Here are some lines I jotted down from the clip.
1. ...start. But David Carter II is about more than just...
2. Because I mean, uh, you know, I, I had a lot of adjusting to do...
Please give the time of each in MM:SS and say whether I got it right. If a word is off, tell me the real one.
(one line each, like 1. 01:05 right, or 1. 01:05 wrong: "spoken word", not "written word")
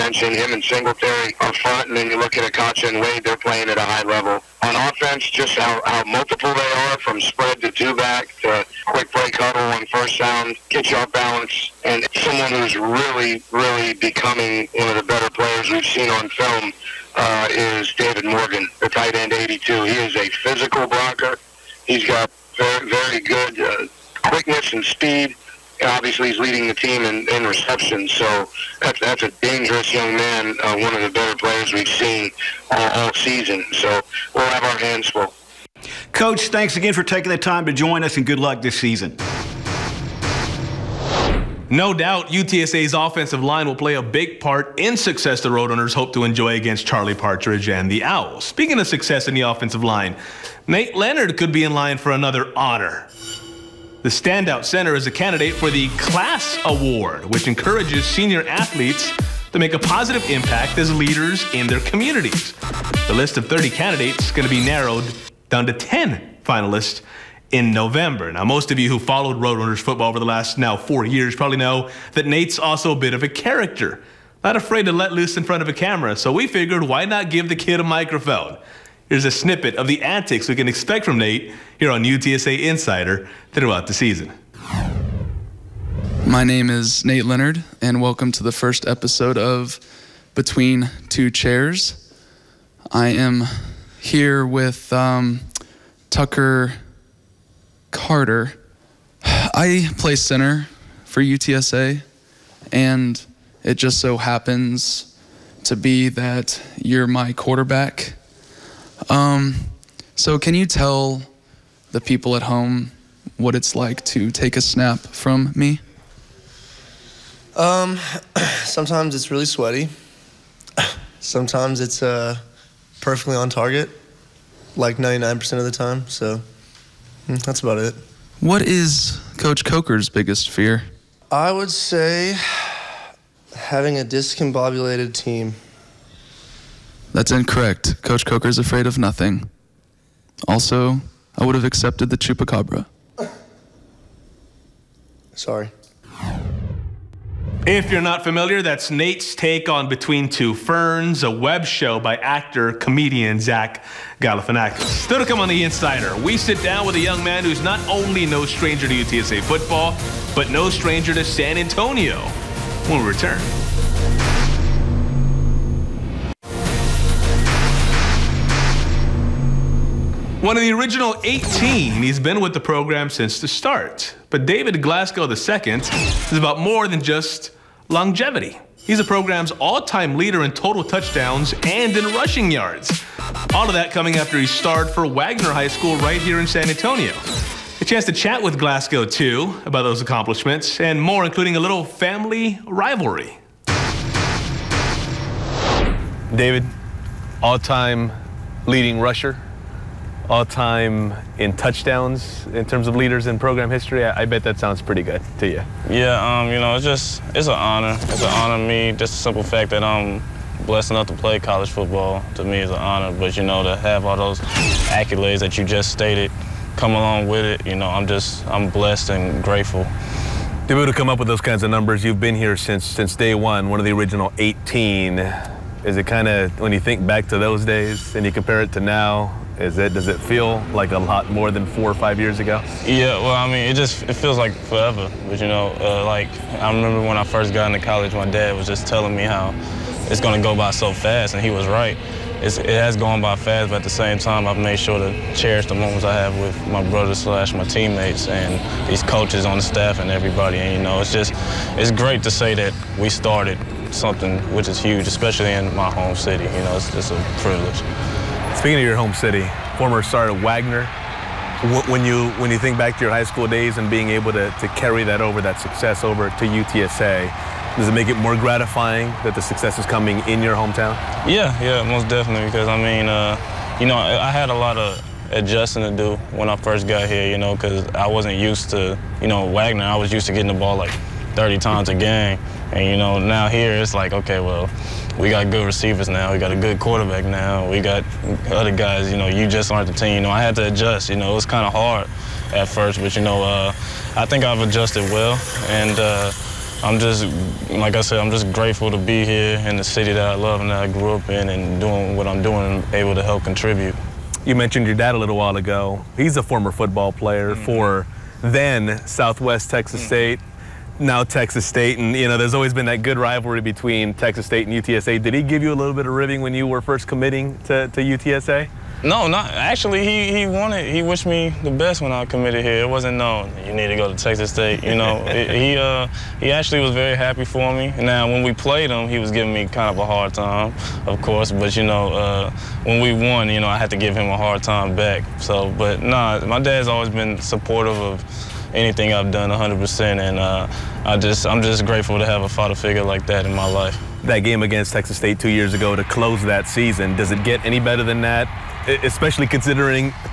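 1. 02:53 wrong: "Glasgow", not "Carter"
2. 04:32 right.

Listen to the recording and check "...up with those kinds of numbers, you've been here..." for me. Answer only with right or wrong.
right.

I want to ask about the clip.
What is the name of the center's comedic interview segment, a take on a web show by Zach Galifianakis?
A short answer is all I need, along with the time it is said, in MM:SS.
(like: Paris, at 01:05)
Between Two Chairs, at 01:30.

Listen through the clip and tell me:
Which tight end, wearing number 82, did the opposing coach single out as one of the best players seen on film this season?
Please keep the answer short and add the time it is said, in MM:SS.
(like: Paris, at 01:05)
David Morgan, at 00:17.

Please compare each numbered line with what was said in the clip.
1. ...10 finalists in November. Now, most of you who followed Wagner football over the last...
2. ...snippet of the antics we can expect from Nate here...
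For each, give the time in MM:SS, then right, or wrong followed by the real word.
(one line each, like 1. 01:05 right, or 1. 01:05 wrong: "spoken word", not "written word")
1. 01:05 wrong: "Roadrunners", not "Wagner"
2. 01:19 right.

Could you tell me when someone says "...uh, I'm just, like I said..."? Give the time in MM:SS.
04:55.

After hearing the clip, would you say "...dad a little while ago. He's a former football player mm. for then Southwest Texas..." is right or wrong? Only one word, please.
right.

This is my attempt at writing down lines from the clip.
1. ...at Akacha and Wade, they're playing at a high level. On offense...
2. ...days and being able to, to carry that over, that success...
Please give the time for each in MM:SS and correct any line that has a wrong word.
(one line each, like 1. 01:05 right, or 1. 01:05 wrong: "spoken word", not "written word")
1. 00:02 right
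2. 04:23 right.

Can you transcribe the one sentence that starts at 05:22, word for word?
It wasn't no, you need to go to Texas State.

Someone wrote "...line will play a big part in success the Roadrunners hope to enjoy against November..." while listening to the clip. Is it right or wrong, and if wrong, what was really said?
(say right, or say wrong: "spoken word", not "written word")
wrong: "Charlie", not "November".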